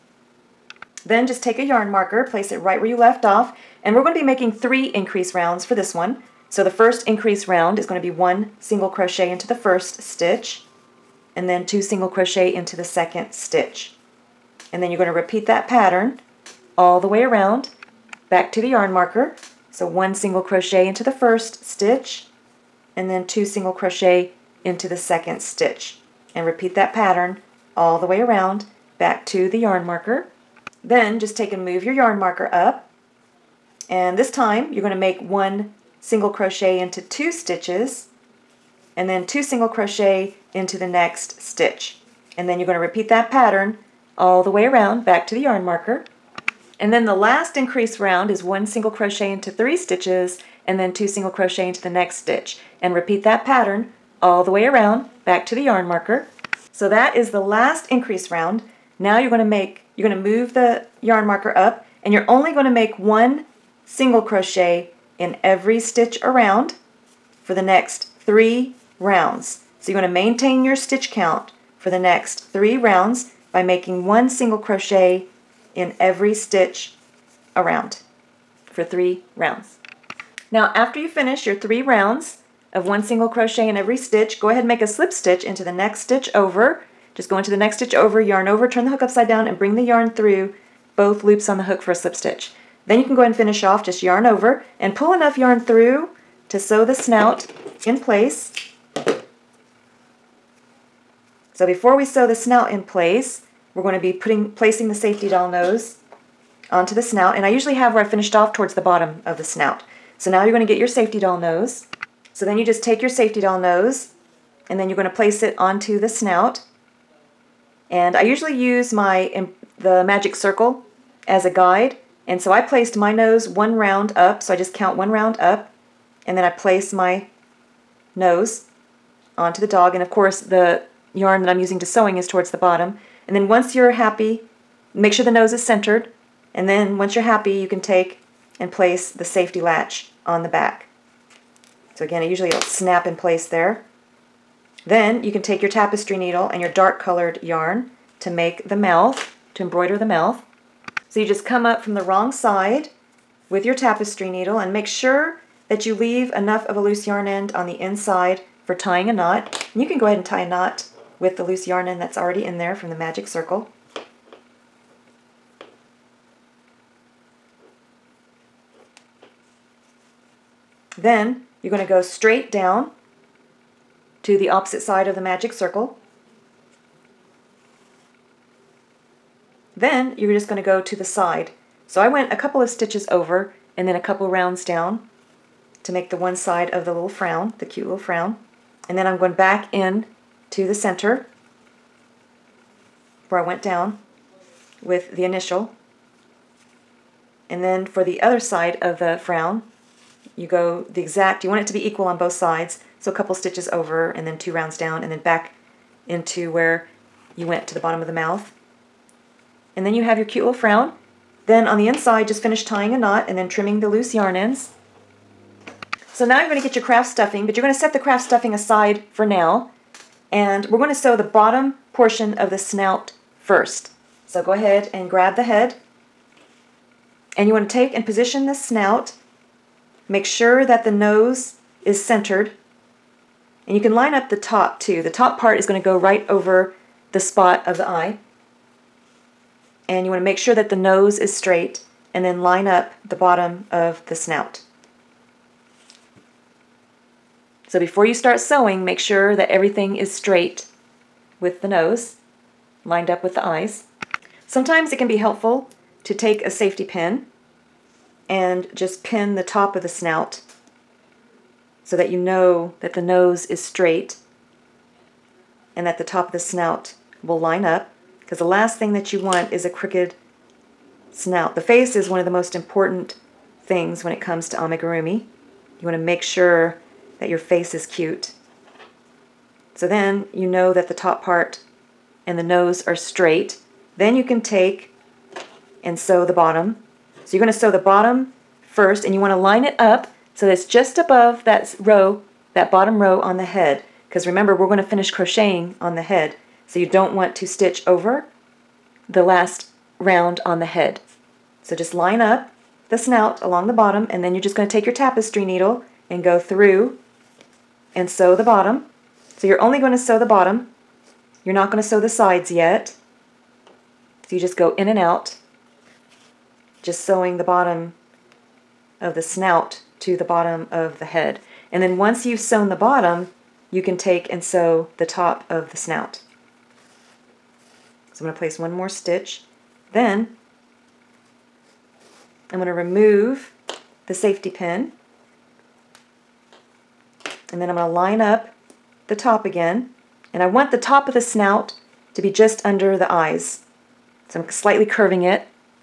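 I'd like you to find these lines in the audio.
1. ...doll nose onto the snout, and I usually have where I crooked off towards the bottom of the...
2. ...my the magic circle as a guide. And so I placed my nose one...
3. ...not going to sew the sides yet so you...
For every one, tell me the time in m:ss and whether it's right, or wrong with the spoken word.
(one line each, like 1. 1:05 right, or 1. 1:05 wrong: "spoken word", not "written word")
1. 1:45 wrong: "finished", not "crooked"
2. 1:58 right
3. 5:11 right.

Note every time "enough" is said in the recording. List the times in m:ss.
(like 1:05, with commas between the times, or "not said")
1:35, 2:36.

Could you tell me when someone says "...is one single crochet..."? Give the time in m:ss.
0:48.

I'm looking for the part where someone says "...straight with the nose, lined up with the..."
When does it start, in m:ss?
4:10.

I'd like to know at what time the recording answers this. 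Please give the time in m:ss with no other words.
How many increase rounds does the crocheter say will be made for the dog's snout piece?
0:04.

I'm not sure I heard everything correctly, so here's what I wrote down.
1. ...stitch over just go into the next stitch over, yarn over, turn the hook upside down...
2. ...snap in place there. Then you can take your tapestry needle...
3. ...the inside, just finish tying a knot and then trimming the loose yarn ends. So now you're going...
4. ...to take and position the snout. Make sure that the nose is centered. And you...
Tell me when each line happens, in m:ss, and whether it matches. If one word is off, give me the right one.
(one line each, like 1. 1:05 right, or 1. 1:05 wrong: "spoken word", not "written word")
1. 1:25 right
2. 2:22 right
3. 3:31 right
4. 3:47 right.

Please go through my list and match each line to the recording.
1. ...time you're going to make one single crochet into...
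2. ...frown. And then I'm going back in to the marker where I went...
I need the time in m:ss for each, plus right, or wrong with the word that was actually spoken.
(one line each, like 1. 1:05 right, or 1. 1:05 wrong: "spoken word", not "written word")
1. 0:34 right
2. 3:07 wrong: "center", not "marker".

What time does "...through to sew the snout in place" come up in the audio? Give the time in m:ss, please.
1:35.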